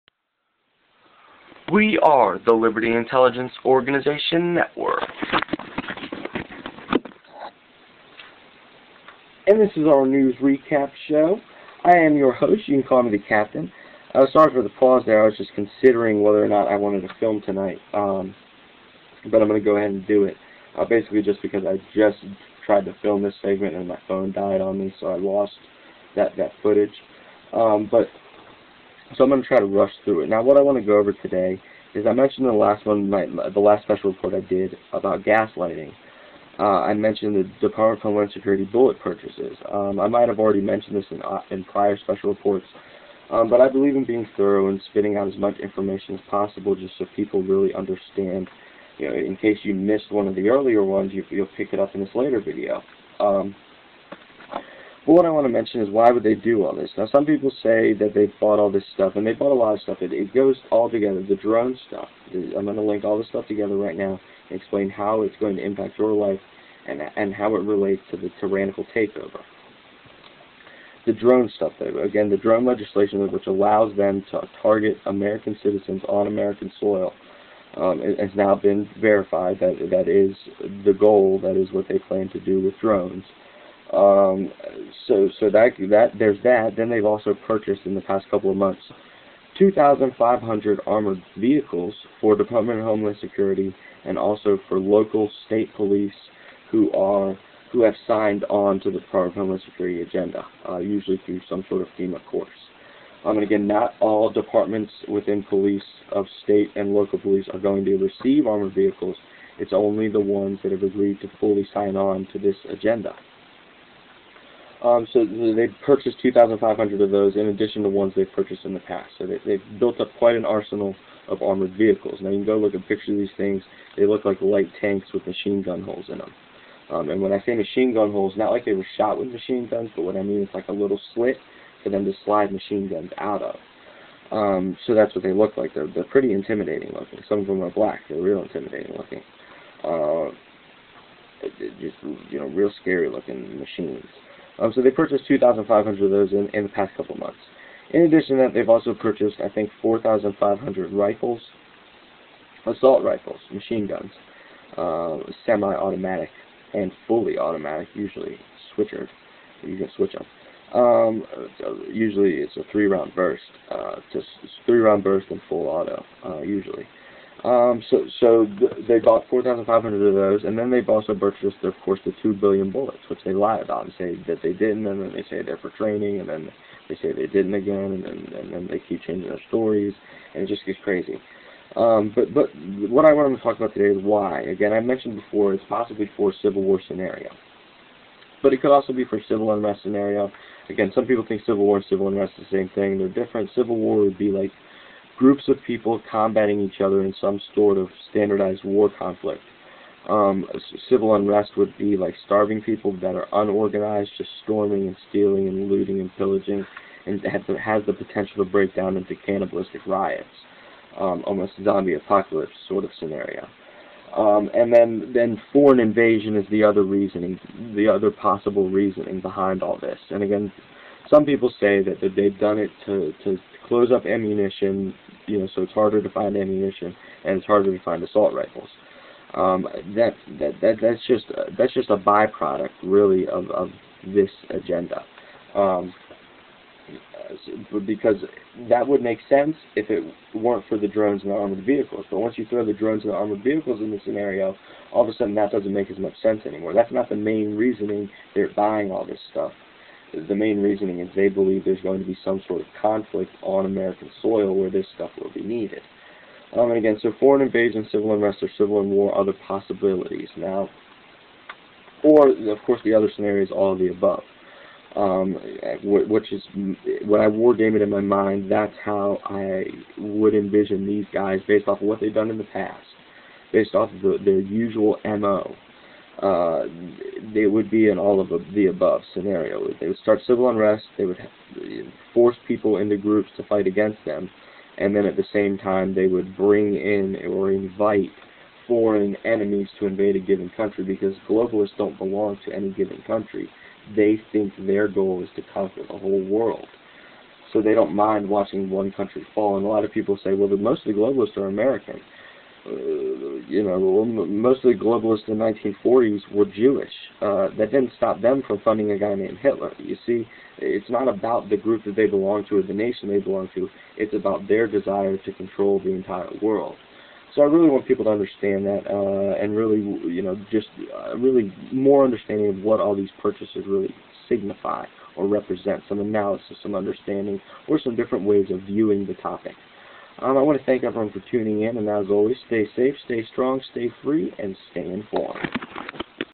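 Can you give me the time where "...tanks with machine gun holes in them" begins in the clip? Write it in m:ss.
2:04.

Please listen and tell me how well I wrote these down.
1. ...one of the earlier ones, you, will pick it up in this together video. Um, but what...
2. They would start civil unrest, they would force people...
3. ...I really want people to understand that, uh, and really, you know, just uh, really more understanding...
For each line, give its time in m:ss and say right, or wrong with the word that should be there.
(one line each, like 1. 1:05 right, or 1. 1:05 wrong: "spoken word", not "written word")
1. 0:50 wrong: "later", not "together"
2. 4:39 right
3. 5:17 right.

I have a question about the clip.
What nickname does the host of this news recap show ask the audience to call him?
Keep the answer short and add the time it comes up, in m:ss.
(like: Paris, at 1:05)
the captain, at 0:13.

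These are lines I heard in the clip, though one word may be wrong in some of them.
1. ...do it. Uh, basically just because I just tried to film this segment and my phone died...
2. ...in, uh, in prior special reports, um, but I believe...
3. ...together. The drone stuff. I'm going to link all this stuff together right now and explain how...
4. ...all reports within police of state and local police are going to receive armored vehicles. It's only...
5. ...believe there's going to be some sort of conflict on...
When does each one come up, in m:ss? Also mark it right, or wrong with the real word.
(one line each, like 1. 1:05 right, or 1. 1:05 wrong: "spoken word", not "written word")
1. 0:20 right
2. 0:41 right
3. 1:00 right
4. 1:43 wrong: "departments", not "reports"
5. 4:11 right.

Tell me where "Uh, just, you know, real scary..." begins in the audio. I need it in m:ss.
2:19.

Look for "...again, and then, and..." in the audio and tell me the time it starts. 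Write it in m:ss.
2:57.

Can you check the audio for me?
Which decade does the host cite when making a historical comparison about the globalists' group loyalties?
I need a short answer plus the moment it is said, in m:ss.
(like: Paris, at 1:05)
1940s, at 5:05.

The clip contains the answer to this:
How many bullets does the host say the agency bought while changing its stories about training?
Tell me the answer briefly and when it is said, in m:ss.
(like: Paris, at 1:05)
2 billion, at 2:52.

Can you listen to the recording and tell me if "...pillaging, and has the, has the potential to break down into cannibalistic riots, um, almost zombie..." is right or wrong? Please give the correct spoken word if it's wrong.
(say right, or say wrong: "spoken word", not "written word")
right.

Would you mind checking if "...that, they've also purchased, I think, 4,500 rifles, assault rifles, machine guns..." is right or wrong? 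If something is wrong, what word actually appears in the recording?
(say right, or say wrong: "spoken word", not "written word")
right.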